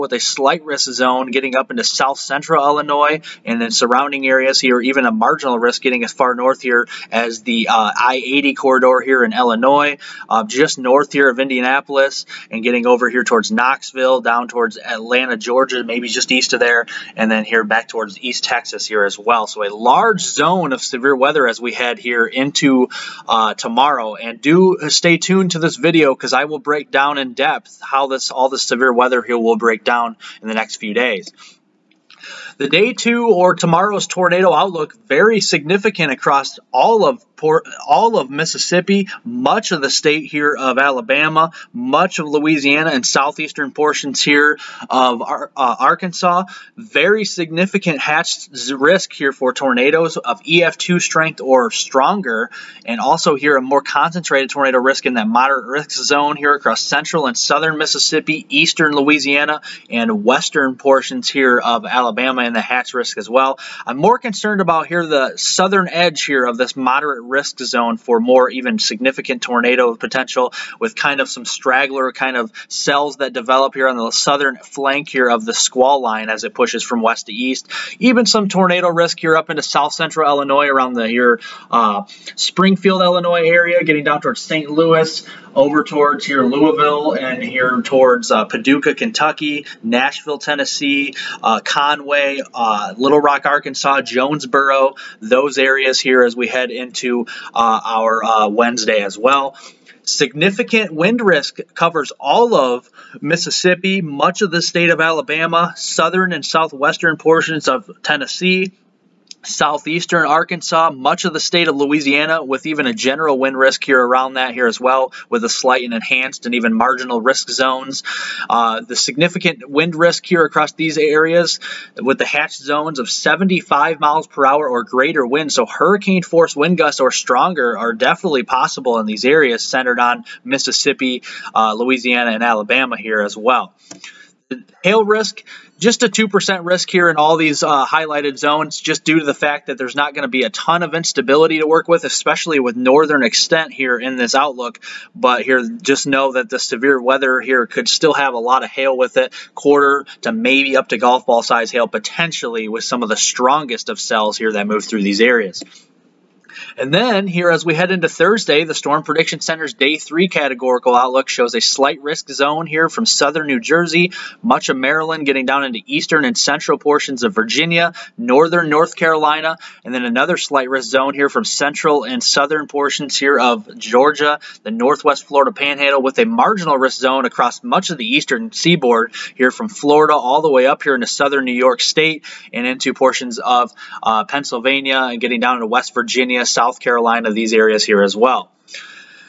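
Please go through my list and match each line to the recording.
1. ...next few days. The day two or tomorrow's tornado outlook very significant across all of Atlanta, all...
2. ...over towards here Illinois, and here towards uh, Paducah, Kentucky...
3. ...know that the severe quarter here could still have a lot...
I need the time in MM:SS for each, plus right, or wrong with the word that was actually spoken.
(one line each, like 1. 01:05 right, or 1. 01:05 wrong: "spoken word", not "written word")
1. 00:30 wrong: "Port", not "Atlanta"
2. 01:25 wrong: "Louisville", not "Illinois"
3. 02:26 wrong: "weather", not "quarter".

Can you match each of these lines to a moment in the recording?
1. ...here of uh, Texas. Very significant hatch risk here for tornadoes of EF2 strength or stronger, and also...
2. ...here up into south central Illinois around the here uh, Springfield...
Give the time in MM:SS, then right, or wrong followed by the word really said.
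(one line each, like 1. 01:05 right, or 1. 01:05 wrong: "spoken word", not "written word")
1. 00:44 wrong: "Arkansas", not "Texas"
2. 01:19 right.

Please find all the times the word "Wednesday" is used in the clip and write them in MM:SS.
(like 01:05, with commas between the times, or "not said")
01:38.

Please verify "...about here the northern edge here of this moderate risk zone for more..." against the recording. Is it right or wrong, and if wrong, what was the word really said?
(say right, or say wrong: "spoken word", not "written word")
wrong: "southern", not "northern".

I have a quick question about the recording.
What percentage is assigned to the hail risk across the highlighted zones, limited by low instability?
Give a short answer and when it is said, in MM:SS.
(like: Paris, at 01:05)
2%, at 02:16.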